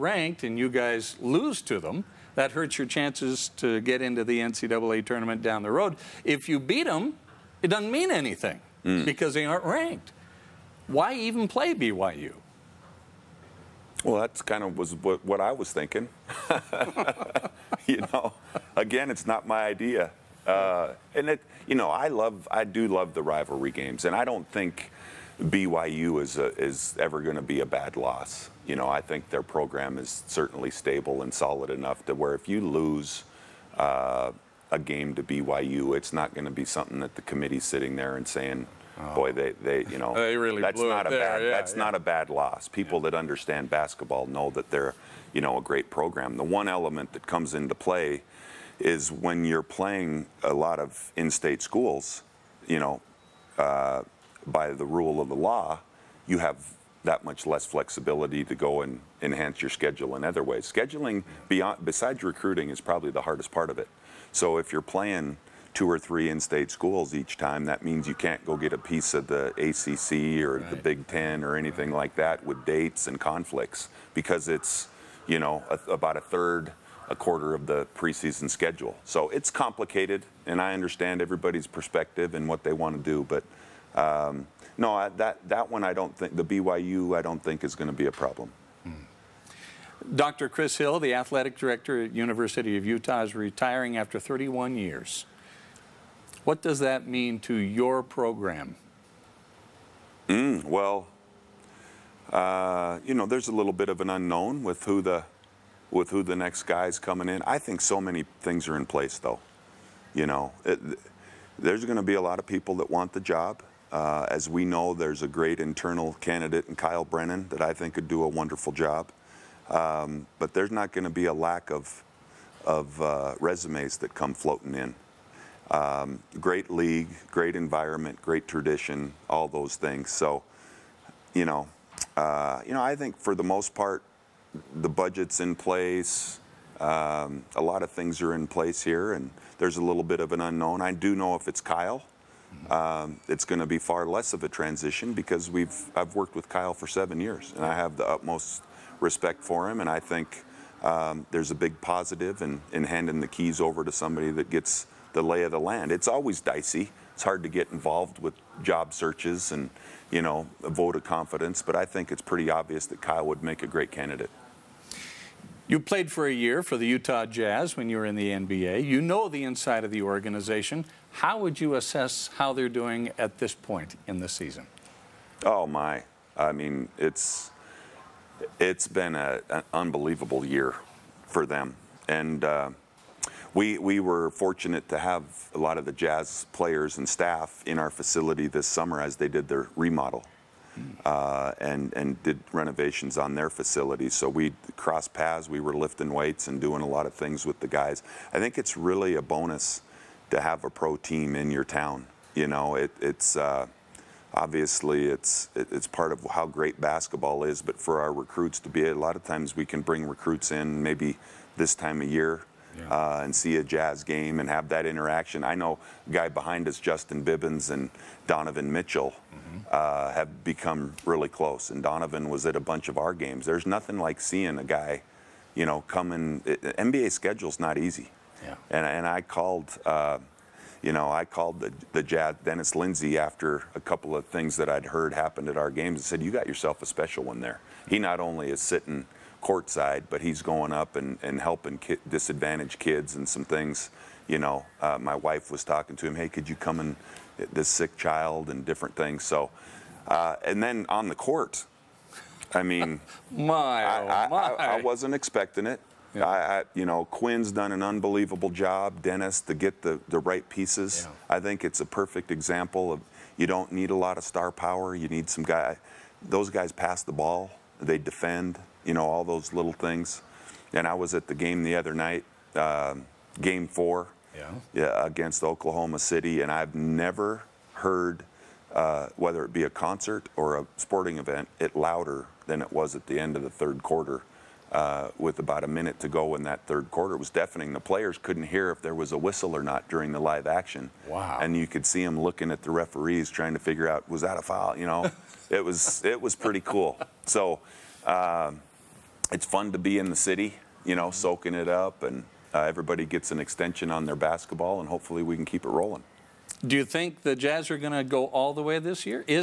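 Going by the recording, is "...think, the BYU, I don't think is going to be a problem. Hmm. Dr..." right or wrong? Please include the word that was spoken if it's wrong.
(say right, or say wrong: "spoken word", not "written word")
right.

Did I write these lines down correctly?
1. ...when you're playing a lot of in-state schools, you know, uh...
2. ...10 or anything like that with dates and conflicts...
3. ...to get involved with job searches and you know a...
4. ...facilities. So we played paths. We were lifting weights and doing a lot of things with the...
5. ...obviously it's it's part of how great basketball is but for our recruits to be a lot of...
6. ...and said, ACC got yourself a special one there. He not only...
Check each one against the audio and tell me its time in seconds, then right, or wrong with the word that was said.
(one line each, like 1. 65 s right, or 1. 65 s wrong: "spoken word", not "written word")
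1. 49 s right
2. 71 s right
3. 157 s right
4. 193 s wrong: "crossed", not "played"
5. 204 s right
6. 235 s wrong: "You", not "ACC".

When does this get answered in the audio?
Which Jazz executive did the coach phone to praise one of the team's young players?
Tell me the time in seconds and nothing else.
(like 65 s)
232 s.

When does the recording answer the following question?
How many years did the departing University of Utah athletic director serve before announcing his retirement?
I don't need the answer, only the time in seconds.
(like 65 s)
94 s.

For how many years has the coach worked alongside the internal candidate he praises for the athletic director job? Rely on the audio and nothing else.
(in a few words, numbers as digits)
7.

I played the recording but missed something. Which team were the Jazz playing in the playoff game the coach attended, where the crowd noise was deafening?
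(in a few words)
Oklahoma City.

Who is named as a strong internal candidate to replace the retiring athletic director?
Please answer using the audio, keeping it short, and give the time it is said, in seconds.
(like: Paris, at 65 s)
Kyle Brennan, at 116 s.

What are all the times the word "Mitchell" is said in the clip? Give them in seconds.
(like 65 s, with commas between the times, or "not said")
218 s.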